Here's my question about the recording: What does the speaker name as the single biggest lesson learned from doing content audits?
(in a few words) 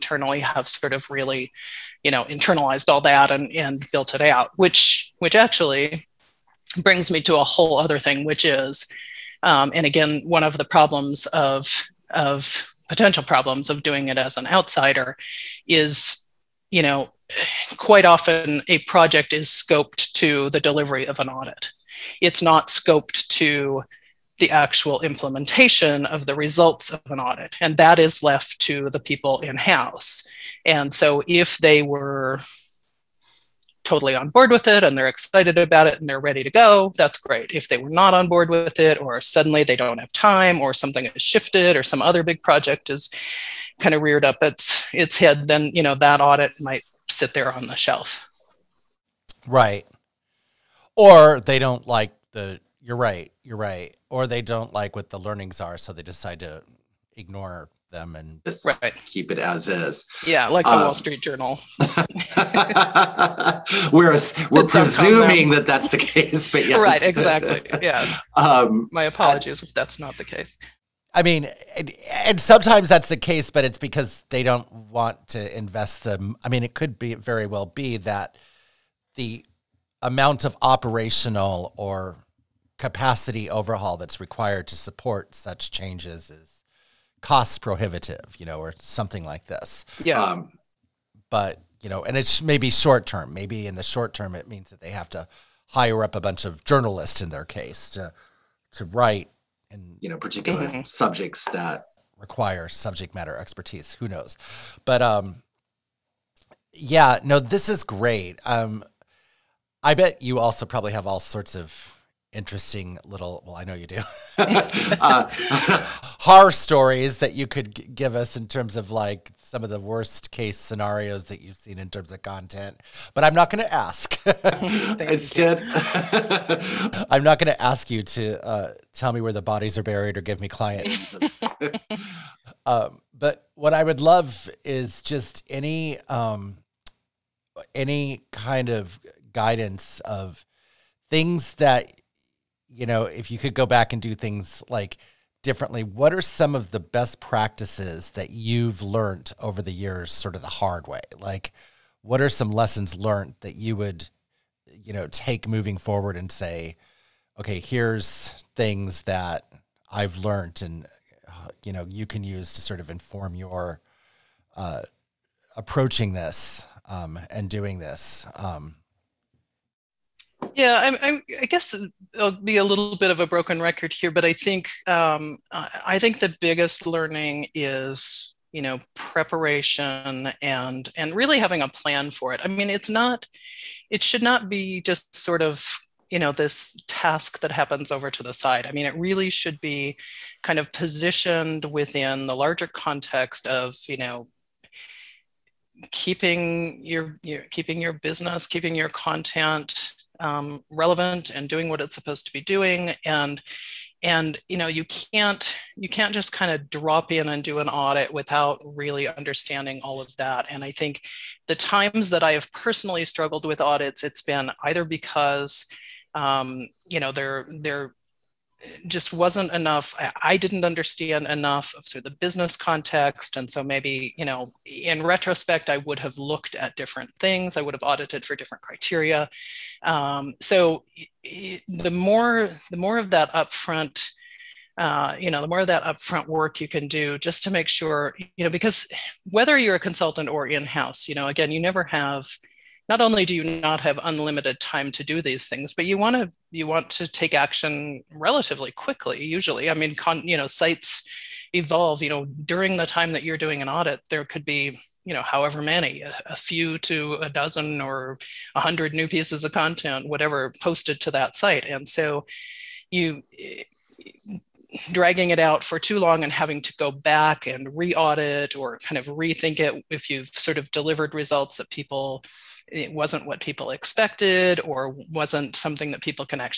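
preparation.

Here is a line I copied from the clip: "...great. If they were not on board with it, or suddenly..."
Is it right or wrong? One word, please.
right.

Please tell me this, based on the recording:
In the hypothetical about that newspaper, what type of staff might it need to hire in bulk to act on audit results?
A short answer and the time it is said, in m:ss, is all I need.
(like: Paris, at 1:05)
journalists, at 1:36.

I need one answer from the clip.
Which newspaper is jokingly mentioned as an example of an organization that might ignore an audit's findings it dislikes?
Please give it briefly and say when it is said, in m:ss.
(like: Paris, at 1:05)
Wall Street Journal, at 1:00.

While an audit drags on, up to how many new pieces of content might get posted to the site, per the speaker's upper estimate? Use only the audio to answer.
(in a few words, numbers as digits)
100.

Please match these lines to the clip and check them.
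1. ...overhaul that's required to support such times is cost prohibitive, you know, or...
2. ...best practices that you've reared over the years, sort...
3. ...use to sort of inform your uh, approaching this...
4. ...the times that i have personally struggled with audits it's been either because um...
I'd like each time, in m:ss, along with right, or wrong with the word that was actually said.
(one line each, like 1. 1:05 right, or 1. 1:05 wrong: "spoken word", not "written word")
1. 1:23 wrong: "changes", not "times"
2. 2:26 wrong: "learned", not "reared"
3. 2:42 right
4. 3:31 right.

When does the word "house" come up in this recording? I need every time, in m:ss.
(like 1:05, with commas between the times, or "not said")
0:29, 4:00.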